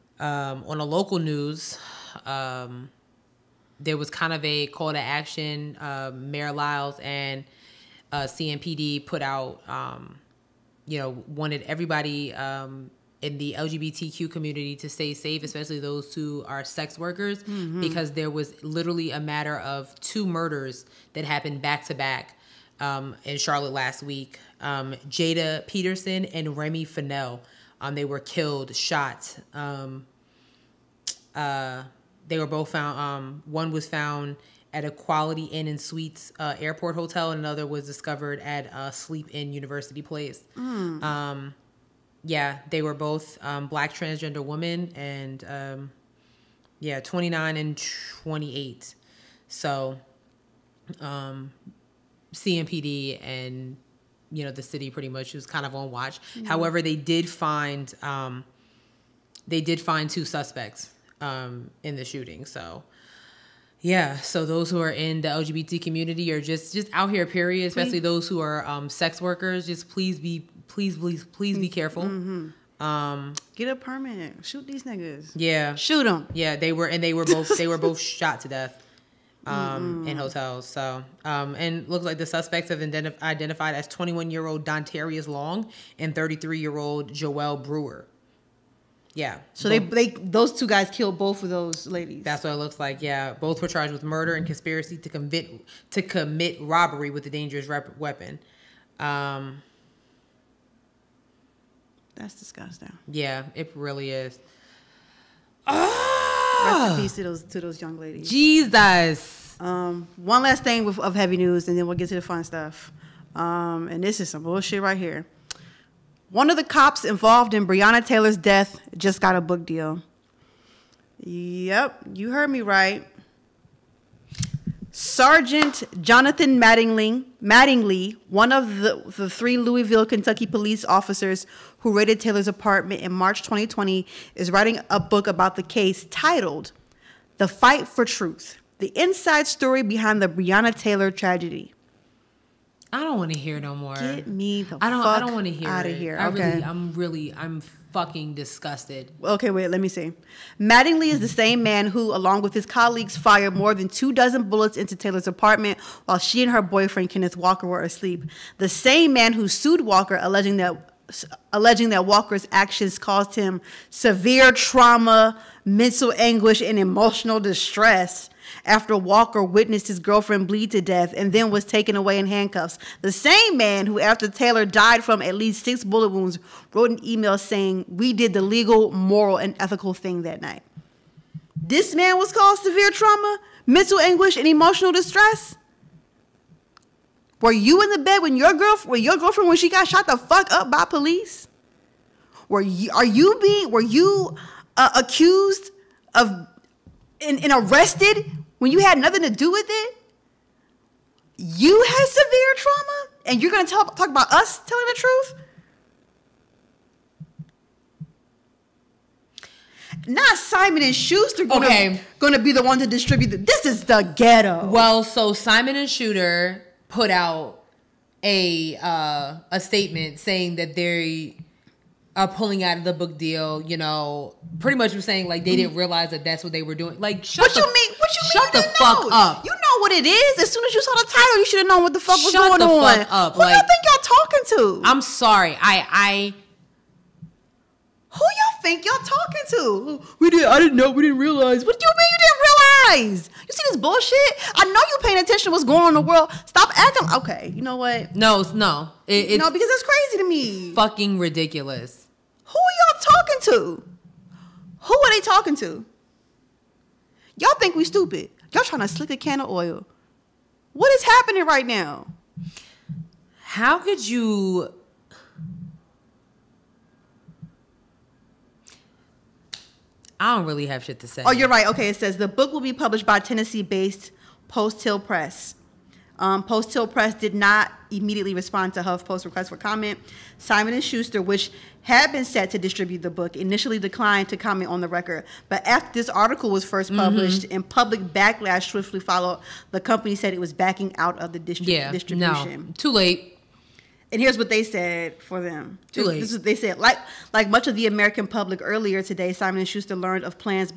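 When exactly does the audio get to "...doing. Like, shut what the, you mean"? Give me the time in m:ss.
3:46.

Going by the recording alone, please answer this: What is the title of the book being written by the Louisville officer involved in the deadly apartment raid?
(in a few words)
The Fight for Truth.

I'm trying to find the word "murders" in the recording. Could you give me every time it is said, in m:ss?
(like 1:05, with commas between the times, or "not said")
0:20, 1:34.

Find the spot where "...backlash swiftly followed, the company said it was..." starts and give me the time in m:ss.
4:48.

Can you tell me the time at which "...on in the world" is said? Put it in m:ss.
4:05.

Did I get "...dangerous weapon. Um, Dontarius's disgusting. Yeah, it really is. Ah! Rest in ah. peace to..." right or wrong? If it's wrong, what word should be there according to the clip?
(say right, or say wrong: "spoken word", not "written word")
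wrong: "That", not "Dontarius".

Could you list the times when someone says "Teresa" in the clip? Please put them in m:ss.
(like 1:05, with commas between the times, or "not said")
not said.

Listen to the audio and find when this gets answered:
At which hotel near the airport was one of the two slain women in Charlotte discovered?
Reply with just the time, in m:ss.
0:34.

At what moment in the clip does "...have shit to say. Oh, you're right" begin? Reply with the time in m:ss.
4:30.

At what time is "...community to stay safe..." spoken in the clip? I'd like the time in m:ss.
0:14.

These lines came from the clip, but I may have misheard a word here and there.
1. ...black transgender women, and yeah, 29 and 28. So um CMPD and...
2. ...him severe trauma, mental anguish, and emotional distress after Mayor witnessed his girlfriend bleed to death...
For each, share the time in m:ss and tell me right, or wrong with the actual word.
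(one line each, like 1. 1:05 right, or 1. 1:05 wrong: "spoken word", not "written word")
1. 0:43 right
2. 2:43 wrong: "Walker", not "Mayor".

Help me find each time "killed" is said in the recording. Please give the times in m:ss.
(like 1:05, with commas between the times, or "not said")
0:28, 1:30.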